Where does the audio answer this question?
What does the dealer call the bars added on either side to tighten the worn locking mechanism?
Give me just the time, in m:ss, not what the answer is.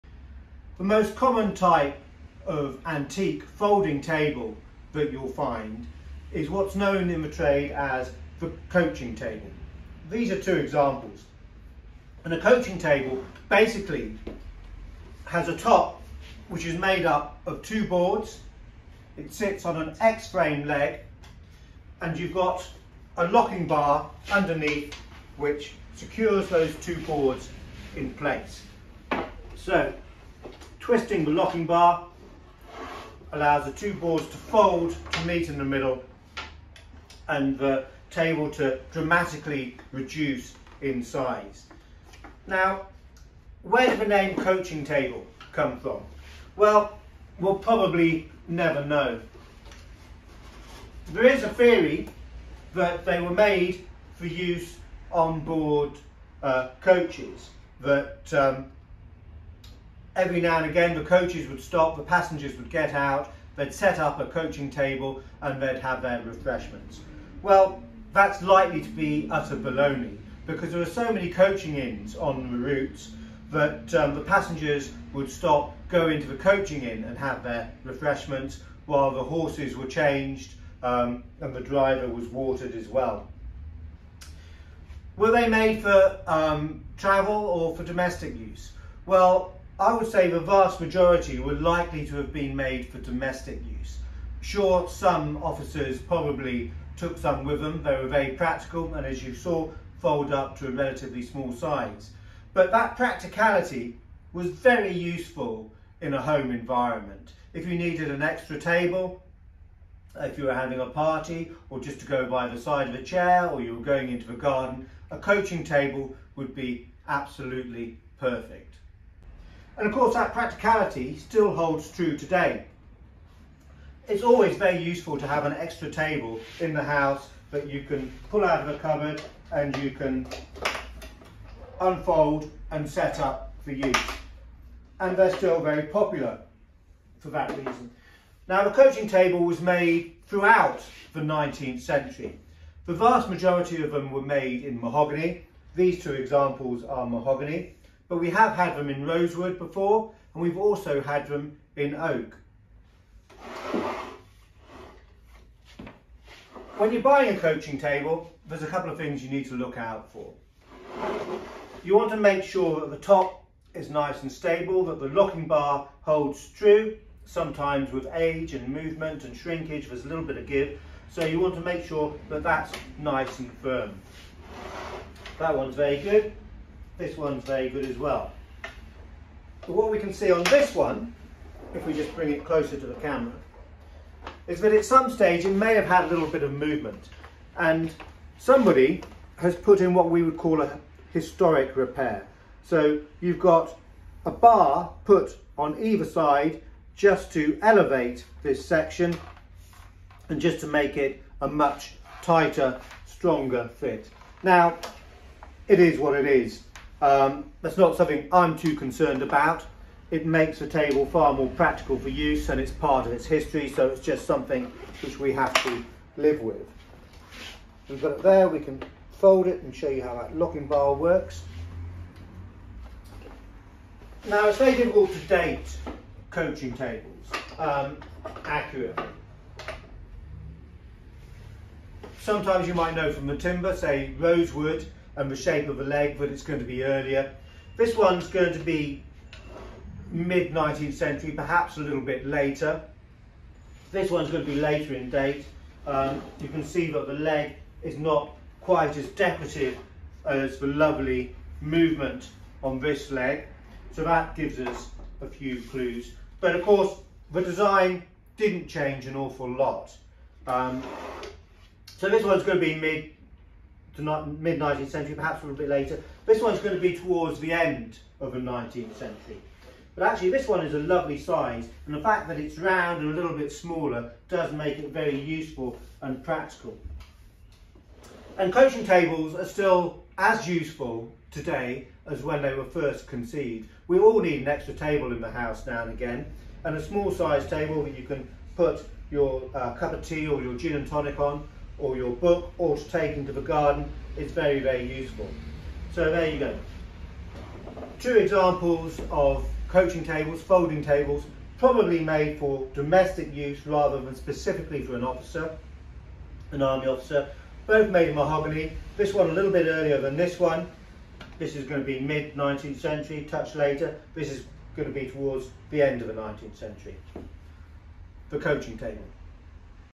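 3:11.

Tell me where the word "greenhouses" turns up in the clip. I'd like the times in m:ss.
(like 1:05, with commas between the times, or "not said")
not said.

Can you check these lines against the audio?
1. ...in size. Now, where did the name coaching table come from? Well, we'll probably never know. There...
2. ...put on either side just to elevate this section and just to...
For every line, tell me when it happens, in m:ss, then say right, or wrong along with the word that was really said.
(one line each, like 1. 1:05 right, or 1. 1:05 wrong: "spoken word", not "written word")
1. 0:40 right
2. 3:15 right.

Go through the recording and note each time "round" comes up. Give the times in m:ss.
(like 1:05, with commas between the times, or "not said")
4:32.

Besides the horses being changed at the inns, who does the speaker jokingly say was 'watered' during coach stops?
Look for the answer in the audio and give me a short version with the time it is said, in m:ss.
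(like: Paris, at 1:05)
the driver, at 1:21.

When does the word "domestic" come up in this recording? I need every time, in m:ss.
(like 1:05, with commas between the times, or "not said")
1:27, 1:32, 5:02.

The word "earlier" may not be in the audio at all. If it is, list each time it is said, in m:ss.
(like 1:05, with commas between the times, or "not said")
3:56, 5:09.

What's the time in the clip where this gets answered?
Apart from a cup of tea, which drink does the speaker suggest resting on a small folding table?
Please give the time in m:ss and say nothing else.
4:50.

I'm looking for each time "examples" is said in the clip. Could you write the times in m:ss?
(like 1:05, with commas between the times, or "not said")
0:10, 2:26, 4:58.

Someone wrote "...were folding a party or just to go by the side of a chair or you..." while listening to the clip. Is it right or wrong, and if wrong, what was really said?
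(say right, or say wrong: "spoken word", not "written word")
wrong: "having", not "folding".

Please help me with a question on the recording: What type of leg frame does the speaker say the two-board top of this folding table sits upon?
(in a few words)
X-frame.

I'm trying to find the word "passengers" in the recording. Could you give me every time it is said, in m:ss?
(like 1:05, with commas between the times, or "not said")
1:02, 1:14.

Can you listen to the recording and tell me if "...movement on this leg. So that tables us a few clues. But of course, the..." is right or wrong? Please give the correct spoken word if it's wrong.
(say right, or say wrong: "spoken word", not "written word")
wrong: "gives", not "tables".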